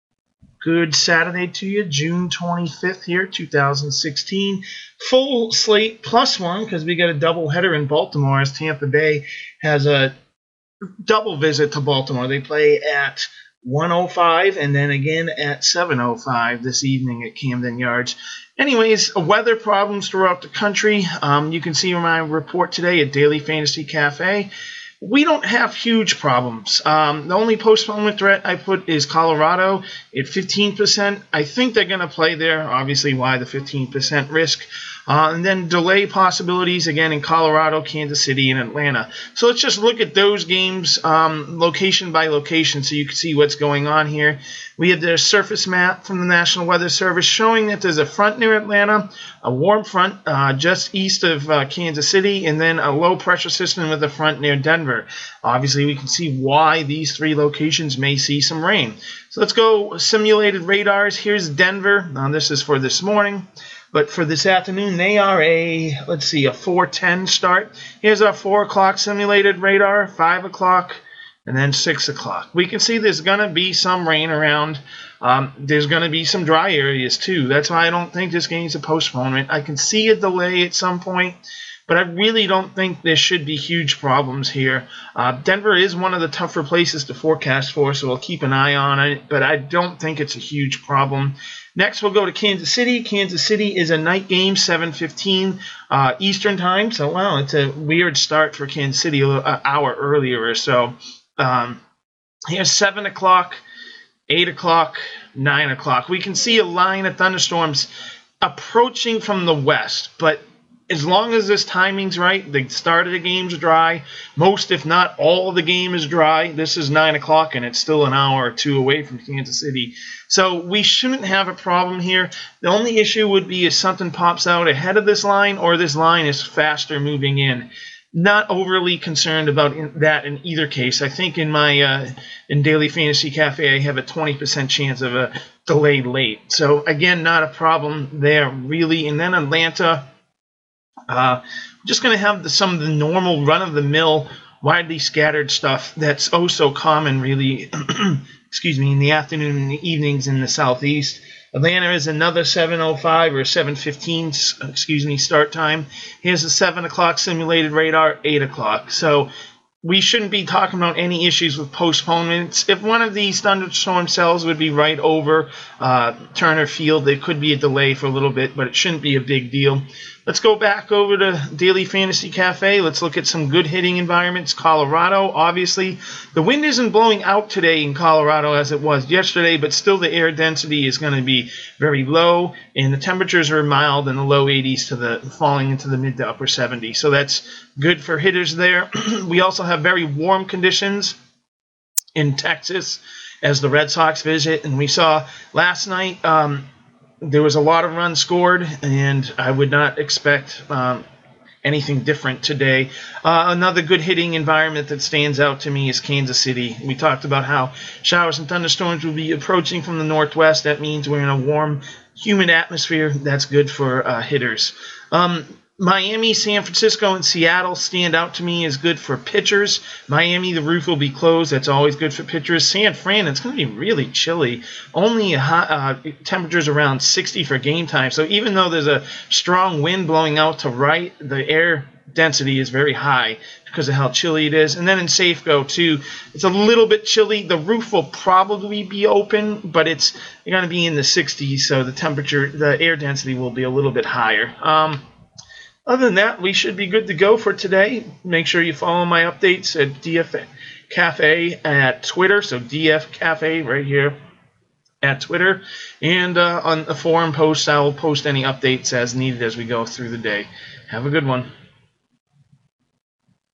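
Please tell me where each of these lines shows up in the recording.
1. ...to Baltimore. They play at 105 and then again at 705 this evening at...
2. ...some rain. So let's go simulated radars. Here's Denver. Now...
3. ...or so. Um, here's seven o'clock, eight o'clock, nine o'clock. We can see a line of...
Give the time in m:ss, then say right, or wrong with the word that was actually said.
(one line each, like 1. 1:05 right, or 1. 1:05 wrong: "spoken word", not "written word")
1. 0:11 right
2. 0:58 right
3. 1:40 right.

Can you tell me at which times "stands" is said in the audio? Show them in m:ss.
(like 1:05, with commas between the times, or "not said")
3:25, 3:37.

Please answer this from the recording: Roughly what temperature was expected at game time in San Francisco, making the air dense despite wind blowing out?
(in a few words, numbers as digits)
60.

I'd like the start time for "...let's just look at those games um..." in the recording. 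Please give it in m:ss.
0:39.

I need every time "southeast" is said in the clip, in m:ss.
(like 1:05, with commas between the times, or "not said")
2:30.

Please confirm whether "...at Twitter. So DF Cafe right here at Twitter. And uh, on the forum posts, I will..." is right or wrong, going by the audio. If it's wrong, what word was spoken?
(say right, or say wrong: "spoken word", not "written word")
right.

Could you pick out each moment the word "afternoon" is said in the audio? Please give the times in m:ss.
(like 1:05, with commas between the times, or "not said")
1:04, 2:29.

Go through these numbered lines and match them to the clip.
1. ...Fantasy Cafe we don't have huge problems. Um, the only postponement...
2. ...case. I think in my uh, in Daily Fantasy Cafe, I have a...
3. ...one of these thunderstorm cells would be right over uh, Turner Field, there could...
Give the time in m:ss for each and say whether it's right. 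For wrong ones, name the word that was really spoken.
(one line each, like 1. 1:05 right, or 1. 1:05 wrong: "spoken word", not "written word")
1. 0:23 right
2. 2:10 right
3. 2:42 right.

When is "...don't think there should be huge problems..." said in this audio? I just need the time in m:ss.
1:22.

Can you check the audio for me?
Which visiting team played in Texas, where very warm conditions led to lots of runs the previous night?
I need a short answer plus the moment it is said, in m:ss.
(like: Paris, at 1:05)
Red Sox, at 3:13.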